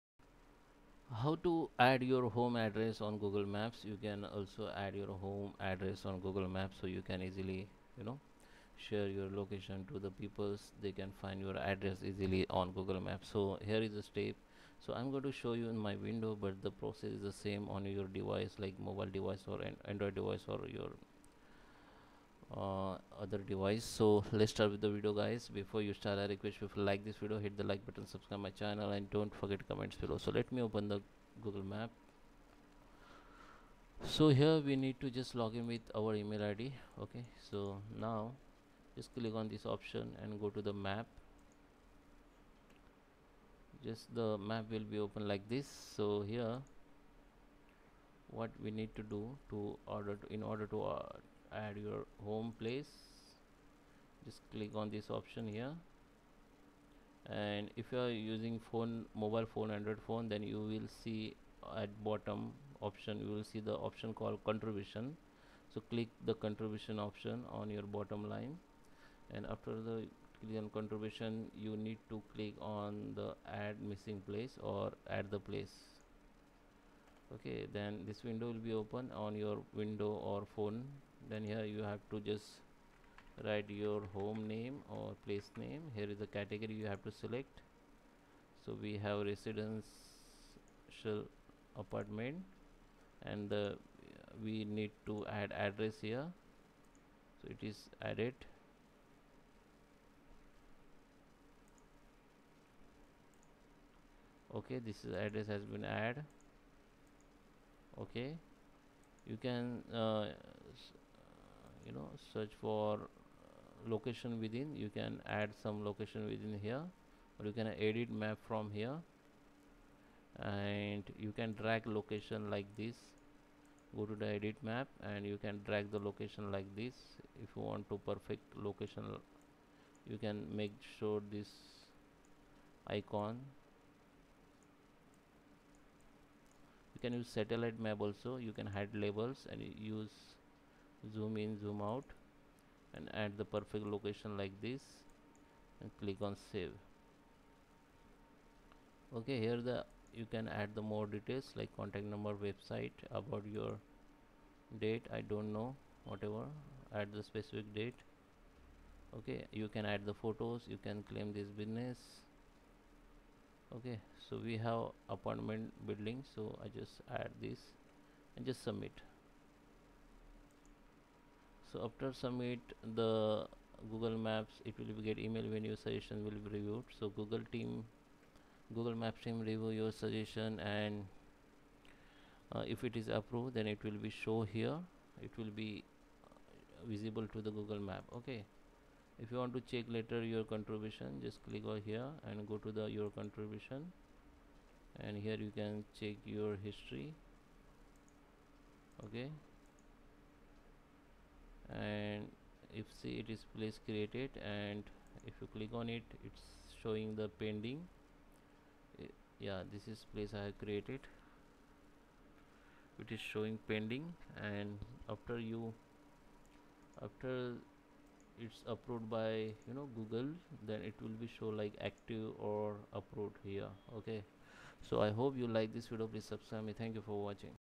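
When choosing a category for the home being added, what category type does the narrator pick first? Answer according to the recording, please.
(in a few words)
Residential.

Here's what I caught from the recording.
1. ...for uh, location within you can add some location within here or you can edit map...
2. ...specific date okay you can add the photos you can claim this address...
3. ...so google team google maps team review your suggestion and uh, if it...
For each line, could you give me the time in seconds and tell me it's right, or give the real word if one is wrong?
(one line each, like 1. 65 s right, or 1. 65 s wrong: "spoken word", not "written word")
1. 112 s right
2. 157 s wrong: "business", not "address"
3. 176 s right.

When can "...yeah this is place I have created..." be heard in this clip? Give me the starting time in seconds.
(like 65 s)
209 s.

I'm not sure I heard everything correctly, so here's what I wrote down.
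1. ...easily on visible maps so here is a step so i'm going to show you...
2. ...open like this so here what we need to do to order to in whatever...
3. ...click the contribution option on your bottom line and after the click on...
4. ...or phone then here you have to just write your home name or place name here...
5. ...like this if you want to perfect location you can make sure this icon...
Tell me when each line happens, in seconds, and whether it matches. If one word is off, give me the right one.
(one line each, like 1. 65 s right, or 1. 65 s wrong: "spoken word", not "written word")
1. 12 s wrong: "google", not "visible"
2. 44 s wrong: "order", not "whatever"
3. 65 s right
4. 80 s right
5. 126 s right.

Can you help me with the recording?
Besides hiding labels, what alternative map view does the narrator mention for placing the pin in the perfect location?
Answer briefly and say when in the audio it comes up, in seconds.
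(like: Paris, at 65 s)
Satellite map, at 137 s.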